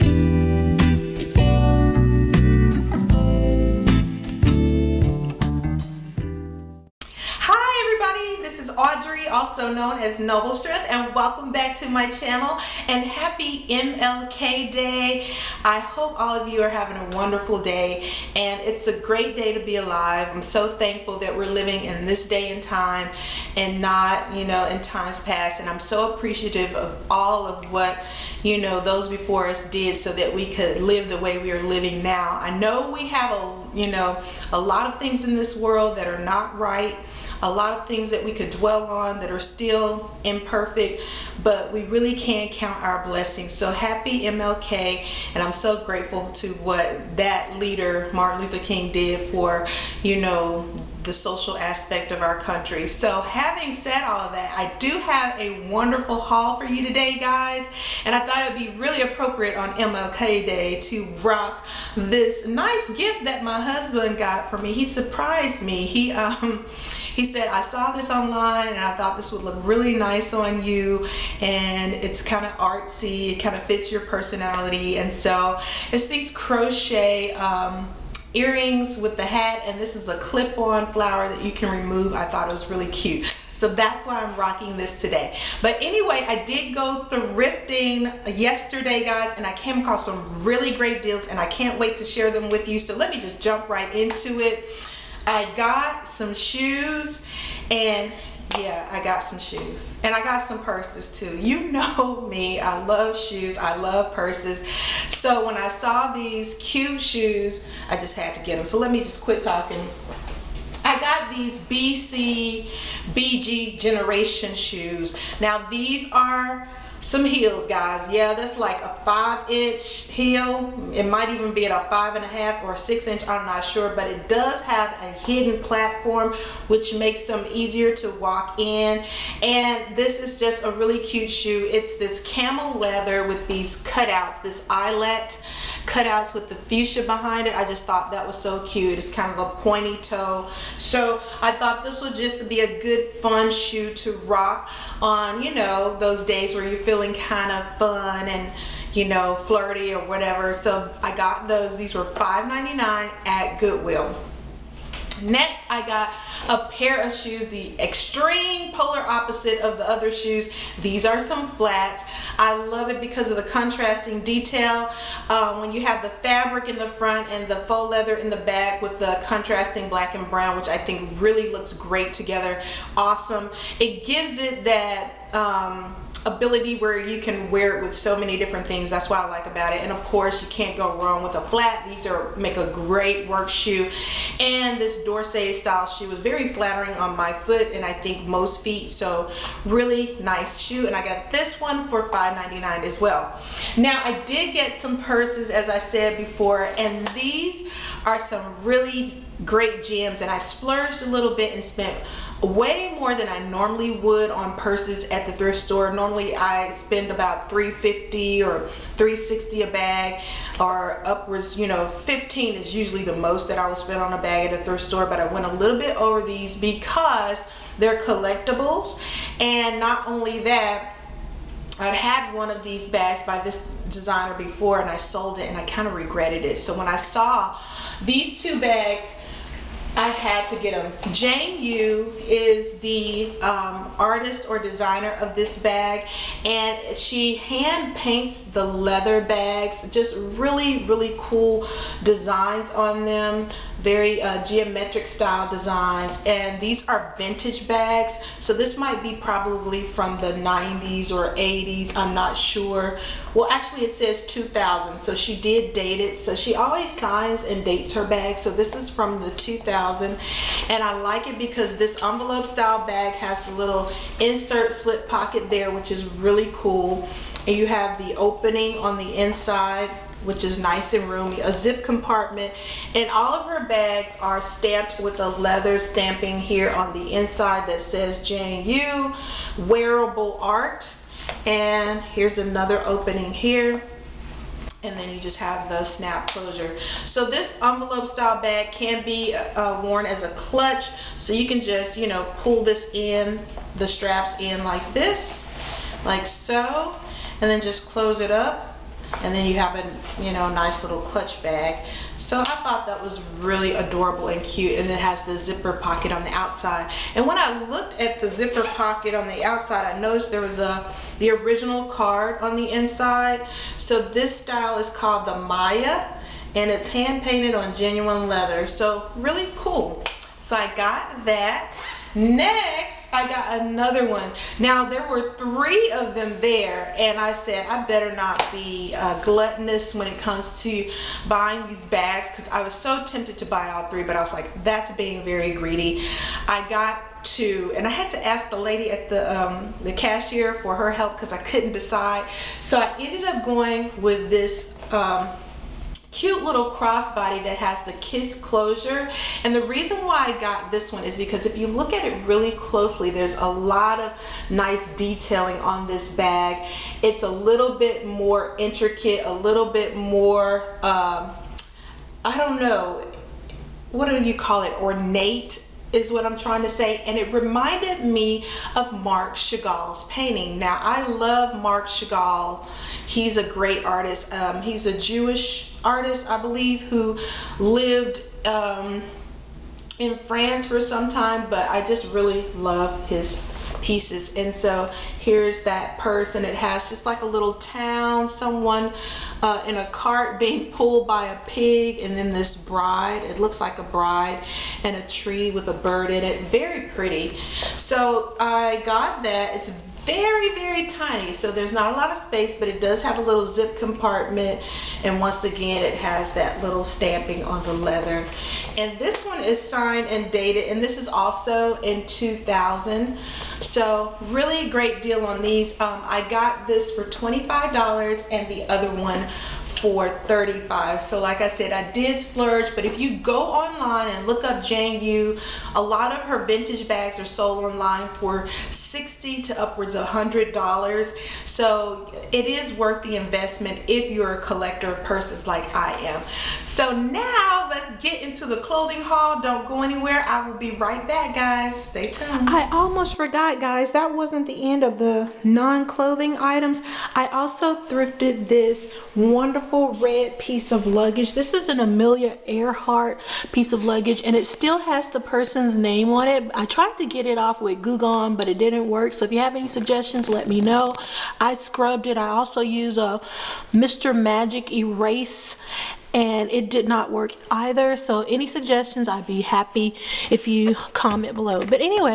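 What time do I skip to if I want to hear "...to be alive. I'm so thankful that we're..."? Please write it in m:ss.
0:19.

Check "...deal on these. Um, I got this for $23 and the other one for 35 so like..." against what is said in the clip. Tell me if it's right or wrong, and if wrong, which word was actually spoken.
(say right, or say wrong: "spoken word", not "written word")
wrong: "25", not "23".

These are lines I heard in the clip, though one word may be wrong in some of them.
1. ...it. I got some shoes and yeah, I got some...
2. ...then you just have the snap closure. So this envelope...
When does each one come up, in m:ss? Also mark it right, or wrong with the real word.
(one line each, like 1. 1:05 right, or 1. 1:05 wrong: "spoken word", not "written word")
1. 1:34 right
2. 4:44 right.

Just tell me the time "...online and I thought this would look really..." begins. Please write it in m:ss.
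1:08.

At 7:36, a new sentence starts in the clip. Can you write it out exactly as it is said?
I tried to get it off with Goo but it didn't work.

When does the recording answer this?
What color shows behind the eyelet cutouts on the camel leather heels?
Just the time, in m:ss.
2:16.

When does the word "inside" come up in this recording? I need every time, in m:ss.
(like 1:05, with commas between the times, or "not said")
4:29, 4:37, 5:12.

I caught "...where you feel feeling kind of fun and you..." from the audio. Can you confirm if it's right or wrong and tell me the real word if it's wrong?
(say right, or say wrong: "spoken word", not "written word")
right.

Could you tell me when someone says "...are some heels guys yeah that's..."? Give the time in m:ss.
1:56.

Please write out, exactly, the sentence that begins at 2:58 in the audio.
That's what I like about it.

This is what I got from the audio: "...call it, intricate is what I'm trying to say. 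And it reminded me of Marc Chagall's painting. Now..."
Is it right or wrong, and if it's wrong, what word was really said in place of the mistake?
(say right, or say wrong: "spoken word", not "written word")
wrong: "ornate", not "intricate".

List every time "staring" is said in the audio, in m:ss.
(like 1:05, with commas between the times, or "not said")
not said.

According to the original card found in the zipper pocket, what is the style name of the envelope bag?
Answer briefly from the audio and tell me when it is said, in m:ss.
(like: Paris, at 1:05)
Maya, at 5:15.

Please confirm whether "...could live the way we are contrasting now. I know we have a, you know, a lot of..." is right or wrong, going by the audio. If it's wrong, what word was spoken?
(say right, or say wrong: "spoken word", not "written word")
wrong: "living", not "contrasting".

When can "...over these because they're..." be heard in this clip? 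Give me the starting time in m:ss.
3:35.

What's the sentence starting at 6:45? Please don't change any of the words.
And once again, it has that little stamping on the leather.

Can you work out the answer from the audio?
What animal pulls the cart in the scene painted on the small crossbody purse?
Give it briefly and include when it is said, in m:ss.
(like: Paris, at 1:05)
Pig, at 6:31.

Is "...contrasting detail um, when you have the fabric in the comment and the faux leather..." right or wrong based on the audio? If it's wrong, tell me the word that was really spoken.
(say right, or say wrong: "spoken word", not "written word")
wrong: "front", not "comment".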